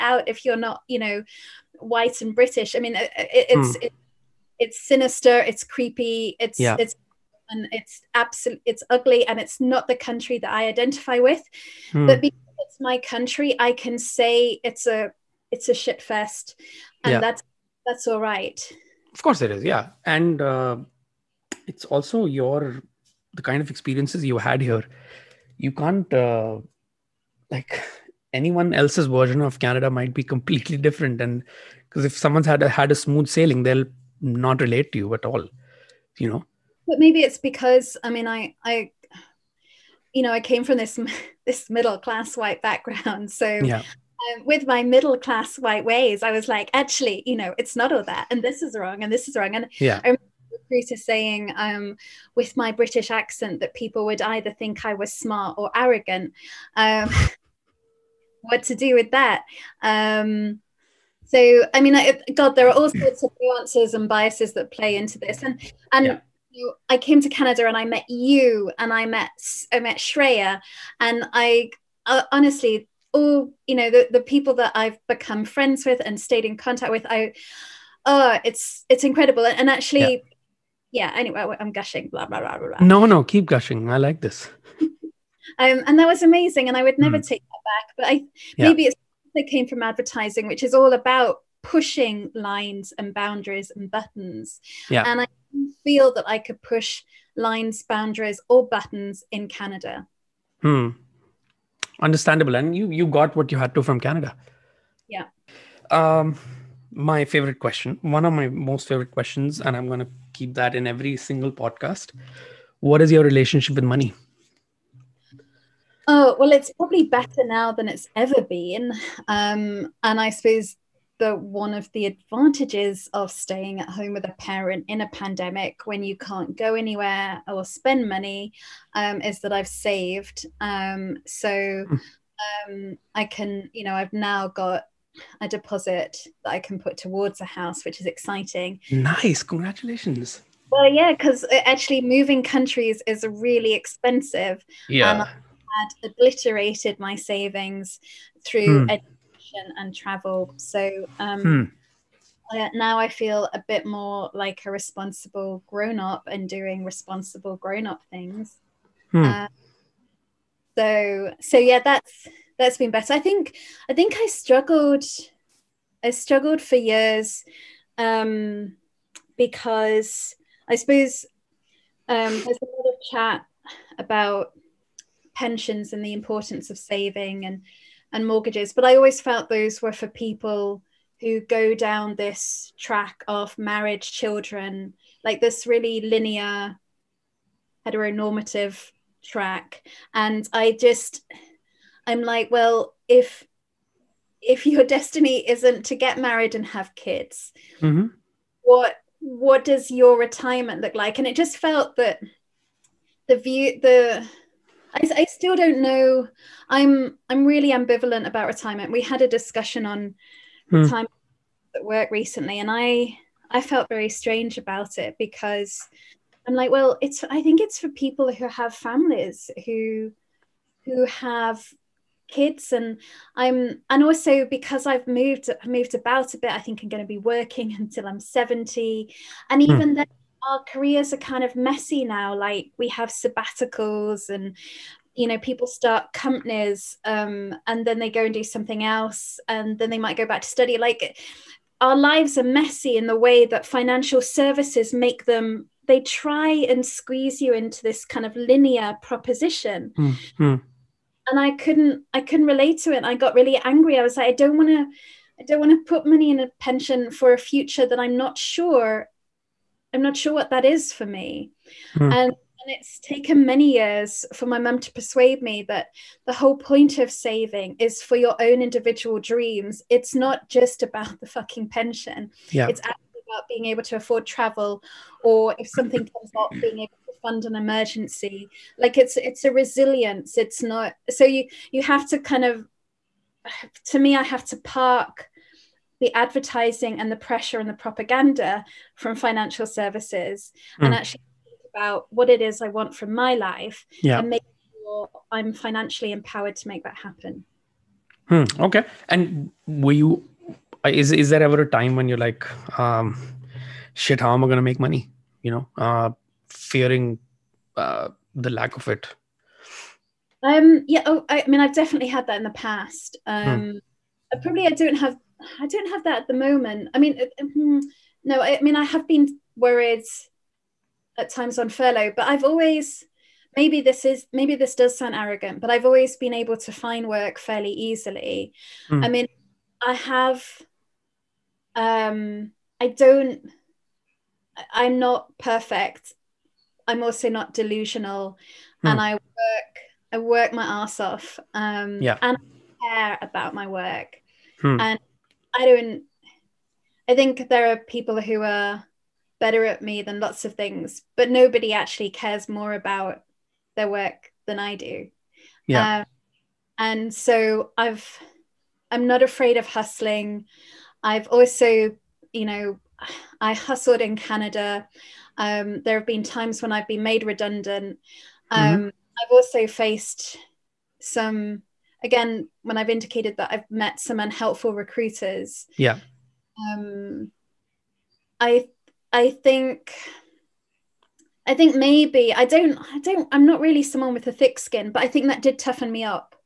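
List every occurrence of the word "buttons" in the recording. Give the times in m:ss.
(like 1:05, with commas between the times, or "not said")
1:33, 1:38.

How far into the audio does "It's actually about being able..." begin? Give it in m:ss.
4:32.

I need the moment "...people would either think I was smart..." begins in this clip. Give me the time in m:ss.
0:53.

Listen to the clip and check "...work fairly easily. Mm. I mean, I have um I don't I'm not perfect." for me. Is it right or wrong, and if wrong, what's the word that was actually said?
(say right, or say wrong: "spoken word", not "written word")
right.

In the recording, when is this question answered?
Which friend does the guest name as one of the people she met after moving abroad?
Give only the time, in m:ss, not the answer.
1:09.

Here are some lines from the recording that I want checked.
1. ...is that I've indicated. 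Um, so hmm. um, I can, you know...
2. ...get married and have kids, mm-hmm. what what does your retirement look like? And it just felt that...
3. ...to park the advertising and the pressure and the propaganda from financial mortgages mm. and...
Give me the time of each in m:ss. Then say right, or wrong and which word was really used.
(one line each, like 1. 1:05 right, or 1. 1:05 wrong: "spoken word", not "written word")
1. 2:09 wrong: "saved", not "indicated"
2. 3:15 right
3. 4:44 wrong: "services", not "mortgages".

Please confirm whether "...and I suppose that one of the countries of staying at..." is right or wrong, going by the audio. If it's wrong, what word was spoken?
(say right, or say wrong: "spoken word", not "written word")
wrong: "advantages", not "countries".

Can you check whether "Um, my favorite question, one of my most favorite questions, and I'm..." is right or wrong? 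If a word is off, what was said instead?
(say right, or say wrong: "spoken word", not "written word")
right.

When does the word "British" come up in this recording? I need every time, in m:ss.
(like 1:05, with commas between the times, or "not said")
0:02, 0:52.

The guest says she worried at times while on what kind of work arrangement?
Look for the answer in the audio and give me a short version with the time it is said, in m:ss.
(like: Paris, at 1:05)
furlough, at 5:21.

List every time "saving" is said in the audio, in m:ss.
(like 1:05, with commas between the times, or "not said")
2:27, 2:56, 4:27.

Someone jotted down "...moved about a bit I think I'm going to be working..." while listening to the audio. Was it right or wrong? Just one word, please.
right.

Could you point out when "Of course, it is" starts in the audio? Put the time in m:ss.
0:19.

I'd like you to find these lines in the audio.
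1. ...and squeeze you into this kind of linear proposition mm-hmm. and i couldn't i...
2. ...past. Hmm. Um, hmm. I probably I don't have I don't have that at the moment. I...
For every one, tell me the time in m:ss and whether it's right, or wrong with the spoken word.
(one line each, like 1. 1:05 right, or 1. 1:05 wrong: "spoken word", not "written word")
1. 4:06 right
2. 5:12 right.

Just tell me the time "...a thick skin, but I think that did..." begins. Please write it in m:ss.
6:24.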